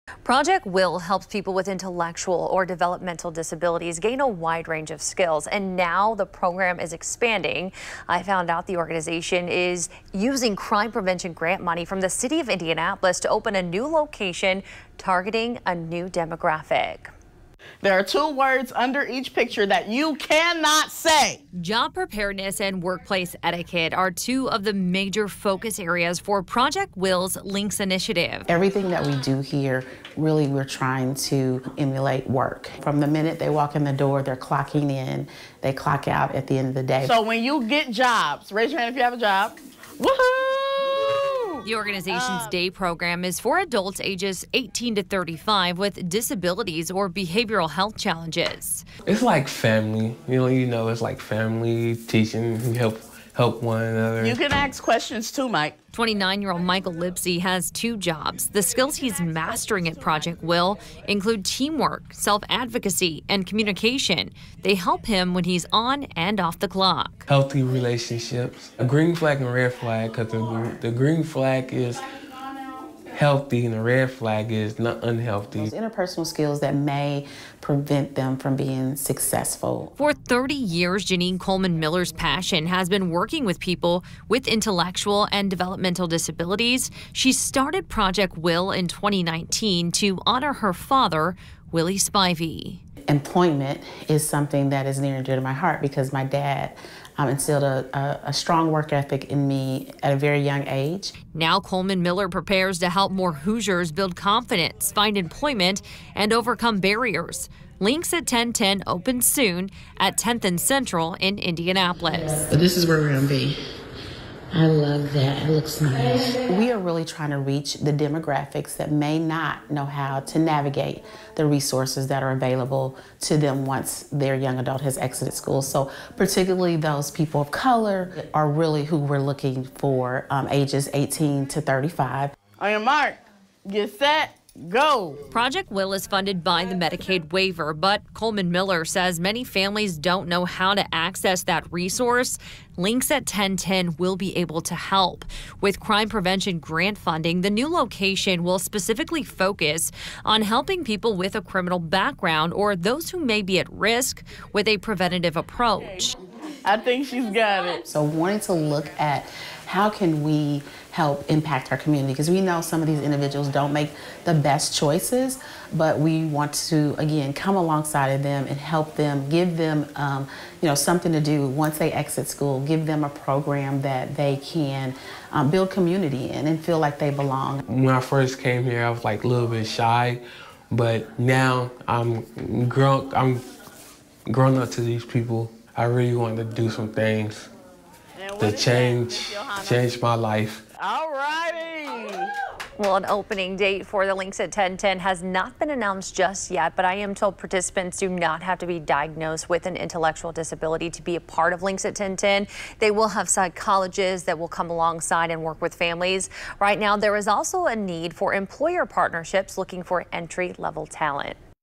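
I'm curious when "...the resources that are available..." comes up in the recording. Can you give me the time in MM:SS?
02:01.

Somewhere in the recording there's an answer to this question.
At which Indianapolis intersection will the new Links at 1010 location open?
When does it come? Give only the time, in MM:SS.
01:50.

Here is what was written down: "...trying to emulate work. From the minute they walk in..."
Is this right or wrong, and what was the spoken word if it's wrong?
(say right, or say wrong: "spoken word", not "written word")
right.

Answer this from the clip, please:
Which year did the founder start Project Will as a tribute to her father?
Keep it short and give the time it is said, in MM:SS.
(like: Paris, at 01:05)
2019, at 01:28.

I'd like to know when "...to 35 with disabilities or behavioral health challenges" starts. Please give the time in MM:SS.
00:44.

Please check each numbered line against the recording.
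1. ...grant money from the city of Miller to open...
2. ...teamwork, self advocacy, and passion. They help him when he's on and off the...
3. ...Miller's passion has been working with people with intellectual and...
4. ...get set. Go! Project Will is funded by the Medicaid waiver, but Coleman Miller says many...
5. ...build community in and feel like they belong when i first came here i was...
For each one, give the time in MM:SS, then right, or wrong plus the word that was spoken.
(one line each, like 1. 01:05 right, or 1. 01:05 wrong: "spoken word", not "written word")
1. 00:11 wrong: "Indianapolis", not "Miller"
2. 01:01 wrong: "communication", not "passion"
3. 01:21 right
4. 02:13 right
5. 02:55 right.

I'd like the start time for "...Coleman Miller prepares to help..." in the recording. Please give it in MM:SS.
01:41.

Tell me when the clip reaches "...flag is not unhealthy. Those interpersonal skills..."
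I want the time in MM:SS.
01:14.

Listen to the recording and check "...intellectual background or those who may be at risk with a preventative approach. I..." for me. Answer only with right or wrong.
wrong.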